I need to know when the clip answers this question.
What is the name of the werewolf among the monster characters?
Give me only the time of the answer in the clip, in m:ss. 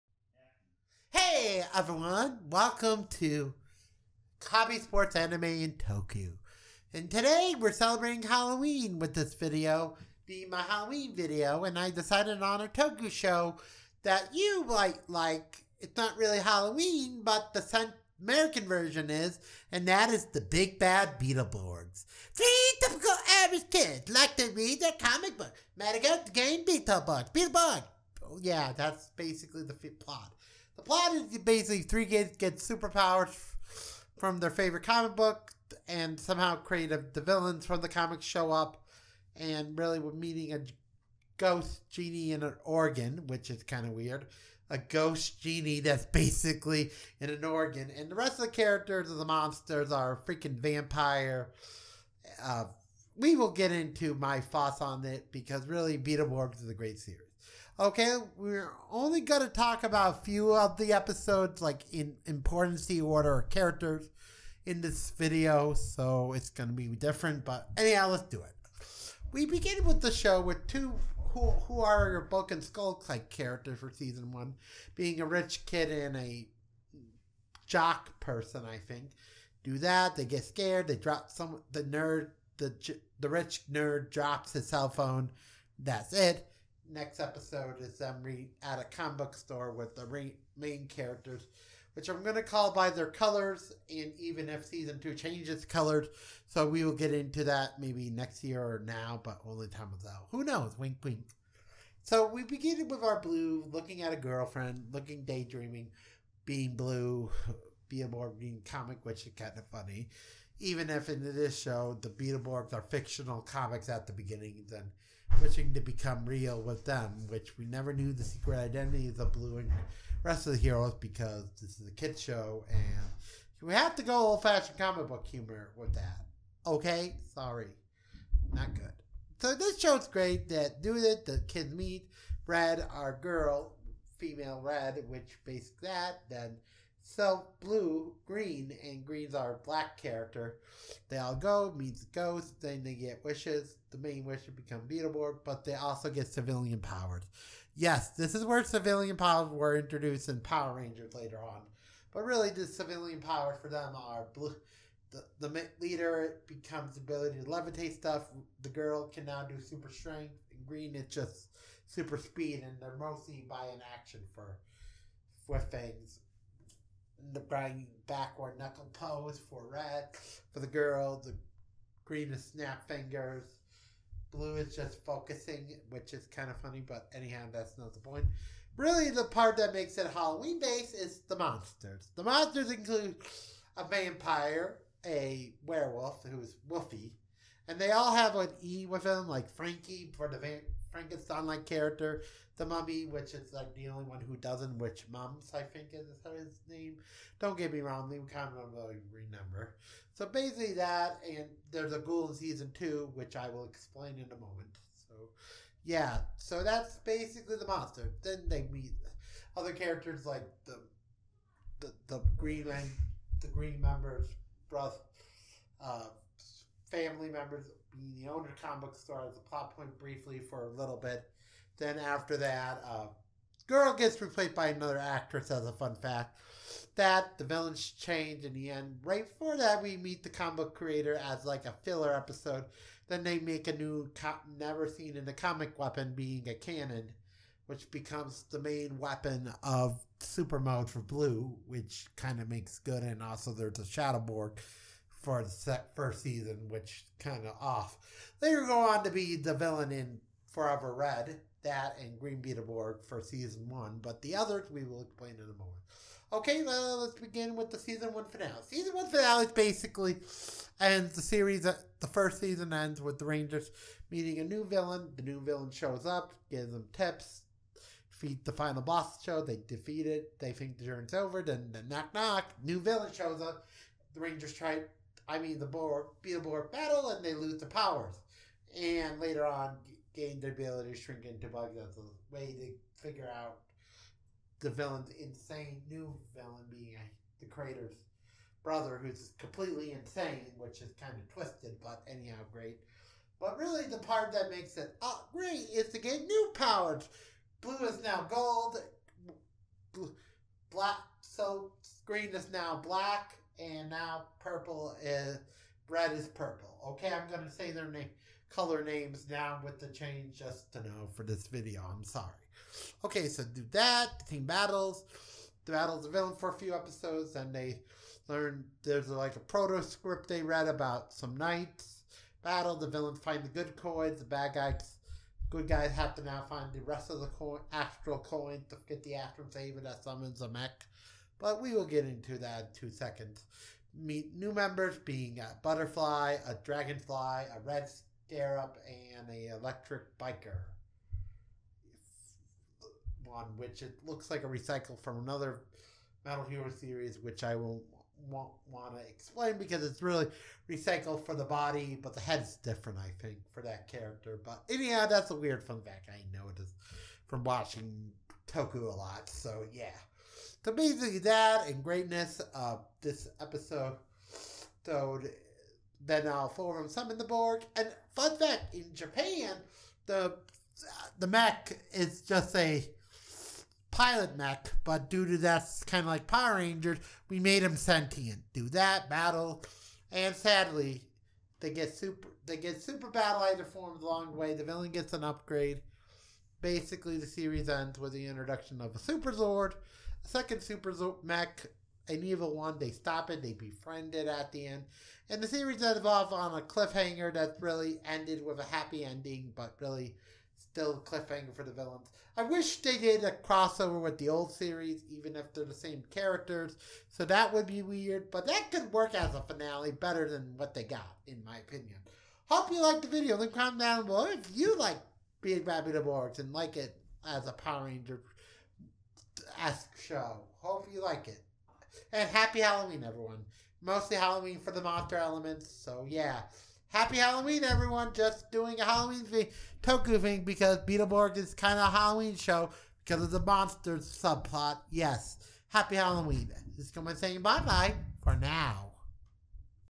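3:06.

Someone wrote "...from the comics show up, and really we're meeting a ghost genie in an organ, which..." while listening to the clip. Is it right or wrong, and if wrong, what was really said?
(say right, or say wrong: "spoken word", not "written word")
right.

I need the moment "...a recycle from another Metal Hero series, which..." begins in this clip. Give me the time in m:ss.
5:44.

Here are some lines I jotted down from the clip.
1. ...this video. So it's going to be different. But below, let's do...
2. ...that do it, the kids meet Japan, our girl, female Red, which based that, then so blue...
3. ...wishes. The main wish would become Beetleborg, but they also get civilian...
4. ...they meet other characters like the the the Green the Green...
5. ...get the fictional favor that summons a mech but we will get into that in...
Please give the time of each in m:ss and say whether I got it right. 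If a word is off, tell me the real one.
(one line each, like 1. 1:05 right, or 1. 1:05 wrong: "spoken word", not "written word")
1. 1:04 wrong: "anyhow", not "below"
2. 2:10 wrong: "Red", not "Japan"
3. 2:23 right
4. 3:28 right
5. 5:28 wrong: "astral", not "fictional".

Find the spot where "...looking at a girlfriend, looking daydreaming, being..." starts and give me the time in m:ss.
1:43.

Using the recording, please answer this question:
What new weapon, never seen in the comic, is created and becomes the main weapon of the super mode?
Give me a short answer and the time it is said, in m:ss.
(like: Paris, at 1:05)
A cannon, at 3:56.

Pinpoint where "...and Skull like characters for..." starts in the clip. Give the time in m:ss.
1:12.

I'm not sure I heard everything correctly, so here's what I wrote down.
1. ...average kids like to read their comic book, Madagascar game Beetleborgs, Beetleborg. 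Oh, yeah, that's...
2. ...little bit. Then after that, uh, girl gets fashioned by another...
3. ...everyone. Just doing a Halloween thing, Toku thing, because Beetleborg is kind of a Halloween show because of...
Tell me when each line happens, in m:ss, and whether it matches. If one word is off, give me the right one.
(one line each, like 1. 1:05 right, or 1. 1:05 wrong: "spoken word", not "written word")
1. 0:23 right
2. 3:40 wrong: "replaced", not "fashioned"
3. 7:07 right.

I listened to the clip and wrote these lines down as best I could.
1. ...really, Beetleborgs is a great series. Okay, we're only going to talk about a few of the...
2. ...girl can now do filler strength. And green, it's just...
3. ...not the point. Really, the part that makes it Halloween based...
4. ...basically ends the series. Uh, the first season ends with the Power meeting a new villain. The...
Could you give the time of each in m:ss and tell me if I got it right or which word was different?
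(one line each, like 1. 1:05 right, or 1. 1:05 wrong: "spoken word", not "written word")
1. 0:55 right
2. 2:38 wrong: "super", not "filler"
3. 2:57 right
4. 4:19 wrong: "Rangers", not "Power".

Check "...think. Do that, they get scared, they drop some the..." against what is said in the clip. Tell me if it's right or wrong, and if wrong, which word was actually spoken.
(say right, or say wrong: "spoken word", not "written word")
right.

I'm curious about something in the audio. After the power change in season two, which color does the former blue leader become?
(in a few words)
Gold.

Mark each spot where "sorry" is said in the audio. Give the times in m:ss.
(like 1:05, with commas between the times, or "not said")
2:07, 5:12.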